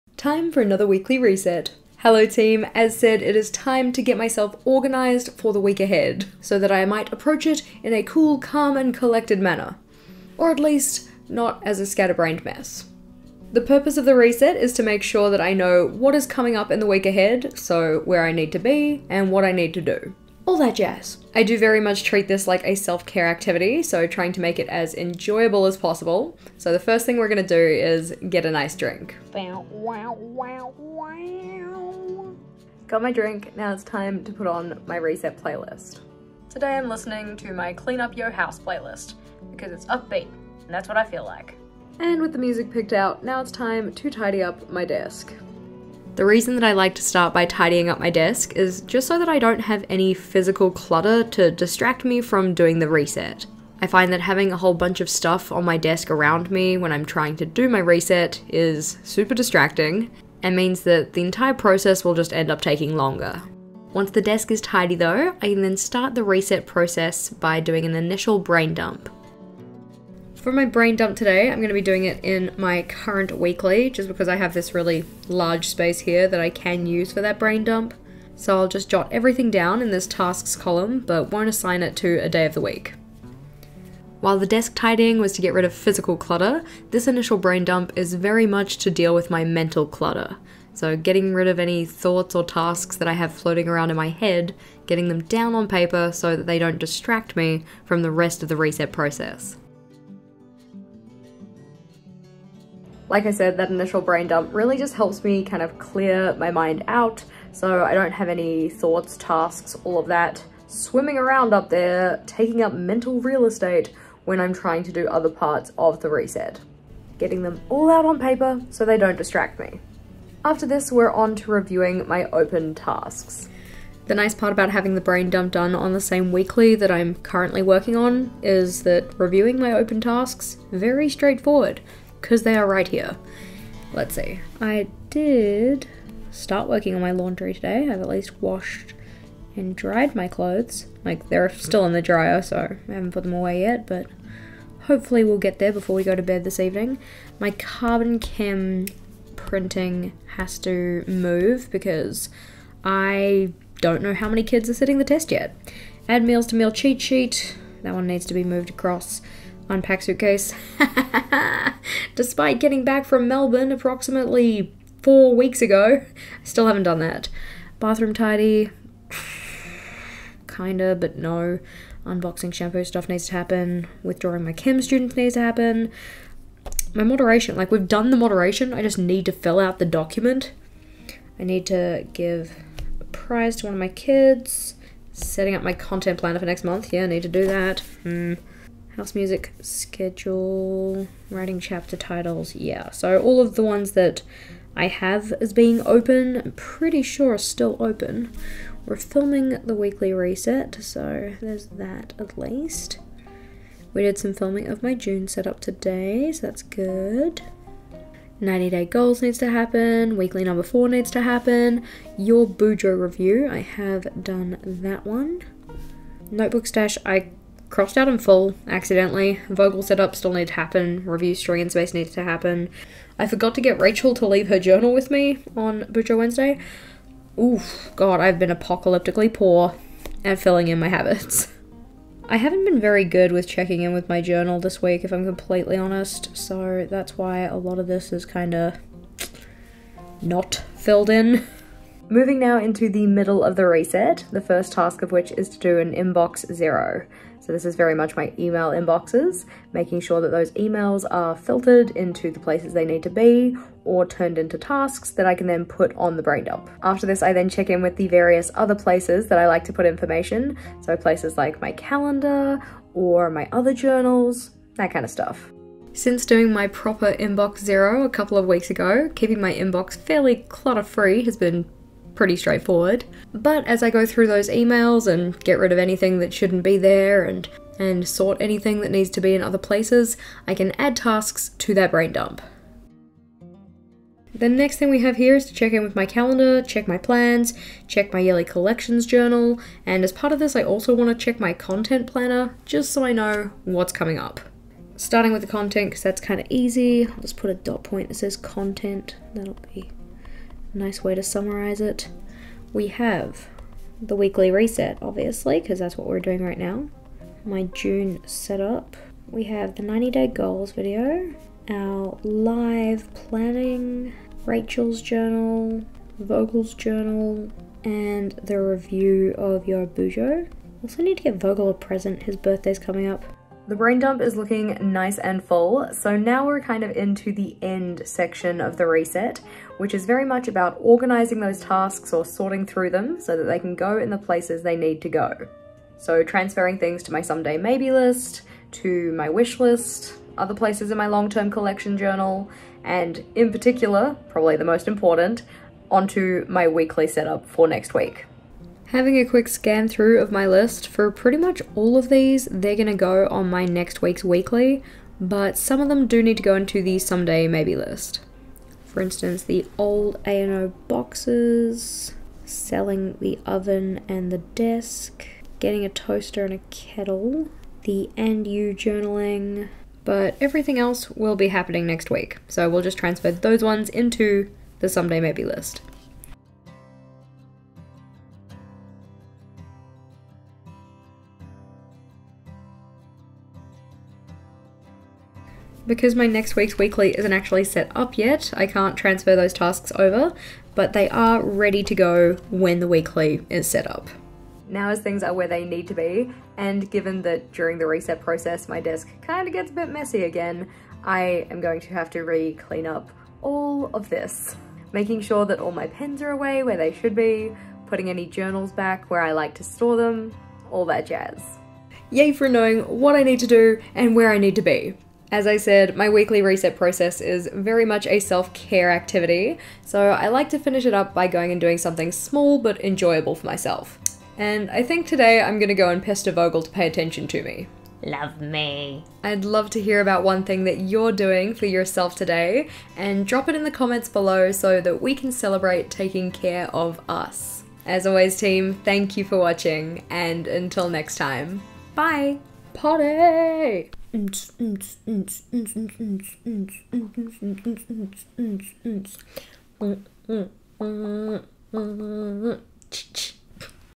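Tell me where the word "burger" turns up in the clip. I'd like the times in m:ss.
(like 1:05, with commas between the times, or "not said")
not said.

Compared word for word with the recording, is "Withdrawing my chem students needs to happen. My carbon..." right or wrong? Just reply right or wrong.
wrong.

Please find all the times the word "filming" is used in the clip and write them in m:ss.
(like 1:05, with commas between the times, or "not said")
3:18, 3:24.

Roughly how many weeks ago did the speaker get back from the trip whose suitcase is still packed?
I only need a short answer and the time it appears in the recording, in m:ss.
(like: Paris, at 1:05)
4 weeks, at 2:45.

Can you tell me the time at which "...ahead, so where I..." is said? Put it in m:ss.
0:17.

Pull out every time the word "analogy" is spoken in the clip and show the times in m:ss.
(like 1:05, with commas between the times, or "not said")
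not said.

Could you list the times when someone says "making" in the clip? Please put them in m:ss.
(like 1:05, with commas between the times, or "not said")
4:09, 6:44.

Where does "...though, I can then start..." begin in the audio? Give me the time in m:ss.
1:04.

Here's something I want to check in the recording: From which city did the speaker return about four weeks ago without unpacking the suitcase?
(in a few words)
Melbourne.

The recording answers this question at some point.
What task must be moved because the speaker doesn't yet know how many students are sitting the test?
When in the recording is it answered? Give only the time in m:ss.
2:27.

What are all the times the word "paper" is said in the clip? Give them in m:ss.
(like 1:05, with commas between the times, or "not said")
1:35, 1:58.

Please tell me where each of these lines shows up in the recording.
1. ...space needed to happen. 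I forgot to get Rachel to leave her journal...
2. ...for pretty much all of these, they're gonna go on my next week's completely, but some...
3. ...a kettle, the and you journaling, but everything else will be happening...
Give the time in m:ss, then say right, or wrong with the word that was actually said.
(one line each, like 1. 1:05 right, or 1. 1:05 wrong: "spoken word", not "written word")
1. 3:41 right
2. 5:50 wrong: "weekly", not "completely"
3. 6:06 right.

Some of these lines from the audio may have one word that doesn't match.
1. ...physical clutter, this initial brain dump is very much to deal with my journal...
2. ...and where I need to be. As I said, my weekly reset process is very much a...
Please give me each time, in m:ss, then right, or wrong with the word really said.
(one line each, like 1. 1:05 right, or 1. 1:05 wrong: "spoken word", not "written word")
1. 1:25 wrong: "mental", not "journal"
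2. 6:53 right.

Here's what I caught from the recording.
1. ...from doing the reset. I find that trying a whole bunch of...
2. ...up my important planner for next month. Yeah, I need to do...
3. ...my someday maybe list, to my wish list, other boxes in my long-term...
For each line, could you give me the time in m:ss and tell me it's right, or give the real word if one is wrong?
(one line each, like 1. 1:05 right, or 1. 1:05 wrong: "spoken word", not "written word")
1. 0:52 wrong: "having", not "trying"
2. 3:05 wrong: "content", not "important"
3. 5:37 wrong: "places", not "boxes".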